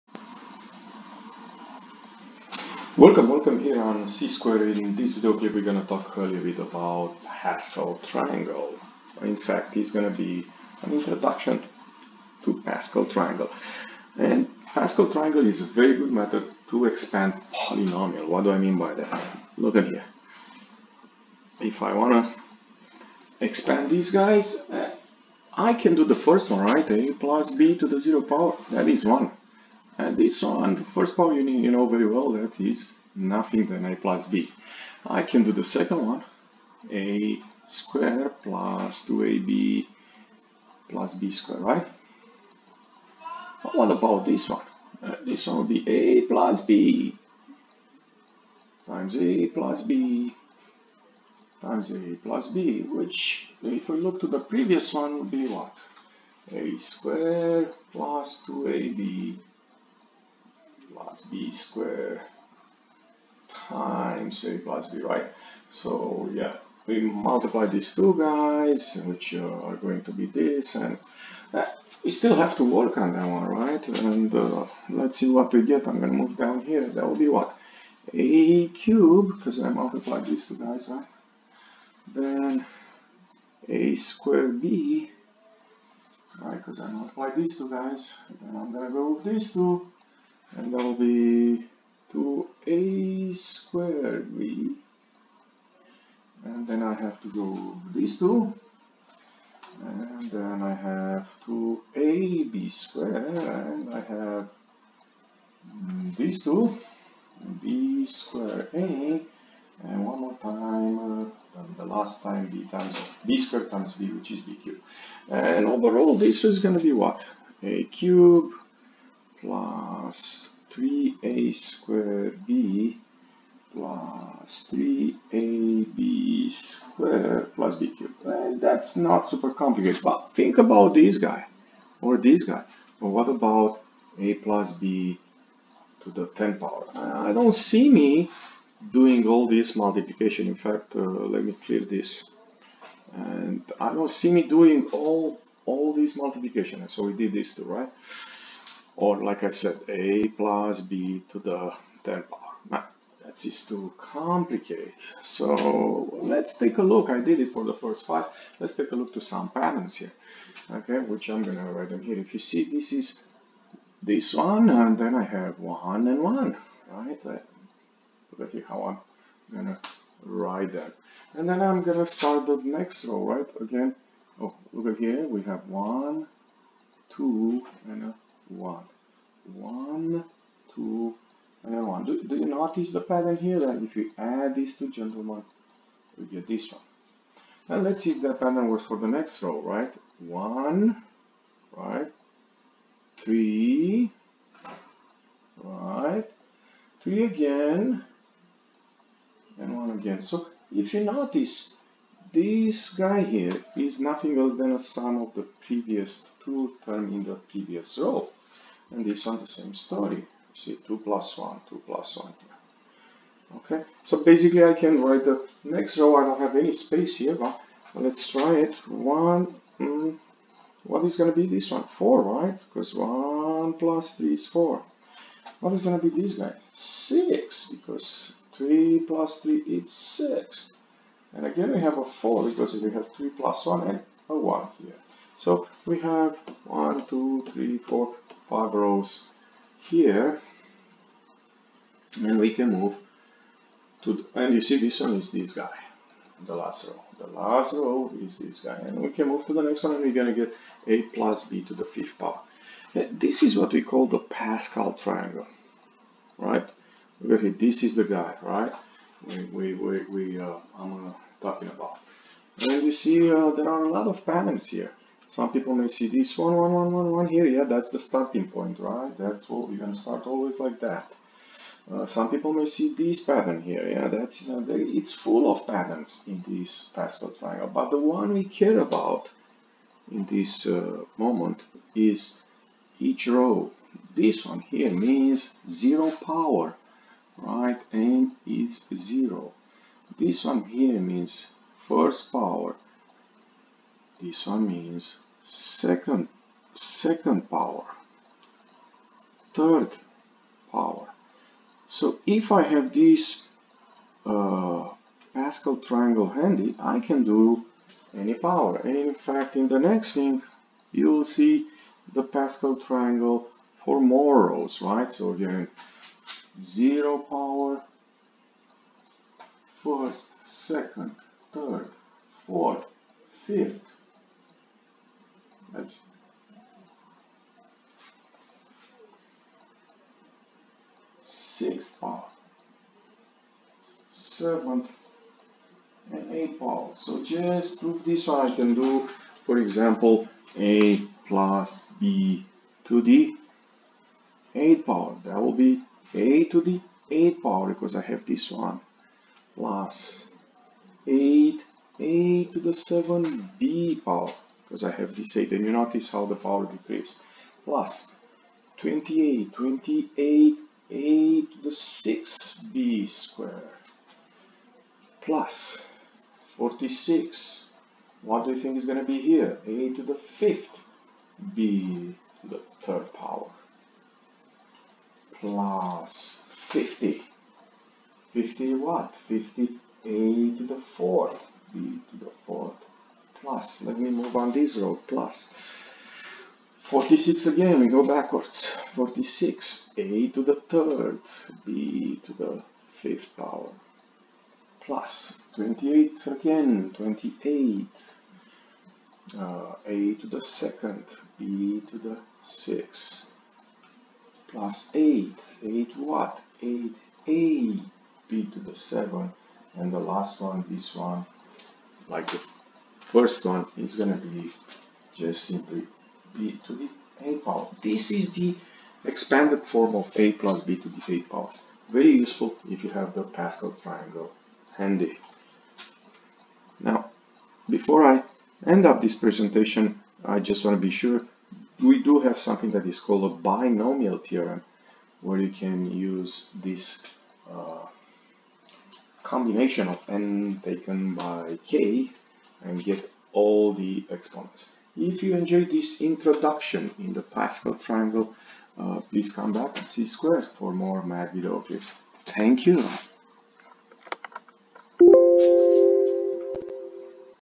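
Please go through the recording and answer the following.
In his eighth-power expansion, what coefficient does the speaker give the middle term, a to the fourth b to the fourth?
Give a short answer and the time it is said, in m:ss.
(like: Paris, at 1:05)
50, at 6:19.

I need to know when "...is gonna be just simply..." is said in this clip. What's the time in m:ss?
6:53.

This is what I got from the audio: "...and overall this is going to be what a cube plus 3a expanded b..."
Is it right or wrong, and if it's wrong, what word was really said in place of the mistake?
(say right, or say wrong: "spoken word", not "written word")
wrong: "squared", not "expanded".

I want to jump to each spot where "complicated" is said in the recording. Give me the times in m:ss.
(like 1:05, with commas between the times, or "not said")
2:09, 2:33.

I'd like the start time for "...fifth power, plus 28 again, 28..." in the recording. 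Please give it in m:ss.
6:32.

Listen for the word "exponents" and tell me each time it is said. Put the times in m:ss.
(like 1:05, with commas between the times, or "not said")
7:24.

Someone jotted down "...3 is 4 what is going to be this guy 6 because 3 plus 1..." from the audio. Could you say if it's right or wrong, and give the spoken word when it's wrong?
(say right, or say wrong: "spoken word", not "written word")
wrong: "3", not "1".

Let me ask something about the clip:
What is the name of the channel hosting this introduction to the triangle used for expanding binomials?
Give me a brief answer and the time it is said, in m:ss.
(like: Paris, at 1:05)
C-Square, at 0:04.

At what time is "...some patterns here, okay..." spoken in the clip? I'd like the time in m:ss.
2:39.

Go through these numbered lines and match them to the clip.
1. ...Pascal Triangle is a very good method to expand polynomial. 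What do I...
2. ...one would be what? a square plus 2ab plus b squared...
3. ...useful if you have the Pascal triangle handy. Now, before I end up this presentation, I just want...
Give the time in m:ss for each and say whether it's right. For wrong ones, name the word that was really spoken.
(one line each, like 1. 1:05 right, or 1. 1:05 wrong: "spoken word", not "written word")
1. 0:14 right
2. 0:54 right
3. 7:02 right.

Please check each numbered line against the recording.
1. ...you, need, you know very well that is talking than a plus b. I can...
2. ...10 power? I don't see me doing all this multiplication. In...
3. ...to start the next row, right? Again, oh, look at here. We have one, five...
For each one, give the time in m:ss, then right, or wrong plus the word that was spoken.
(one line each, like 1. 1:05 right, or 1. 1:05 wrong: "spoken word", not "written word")
1. 0:31 wrong: "nothing", not "talking"
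2. 2:16 right
3. 2:52 wrong: "two", not "five".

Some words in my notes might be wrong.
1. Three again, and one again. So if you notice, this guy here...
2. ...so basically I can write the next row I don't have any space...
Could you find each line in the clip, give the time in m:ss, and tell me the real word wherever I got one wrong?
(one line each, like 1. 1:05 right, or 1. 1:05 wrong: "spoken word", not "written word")
1. 3:16 right
2. 3:34 right.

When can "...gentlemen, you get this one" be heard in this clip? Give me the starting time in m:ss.
3:04.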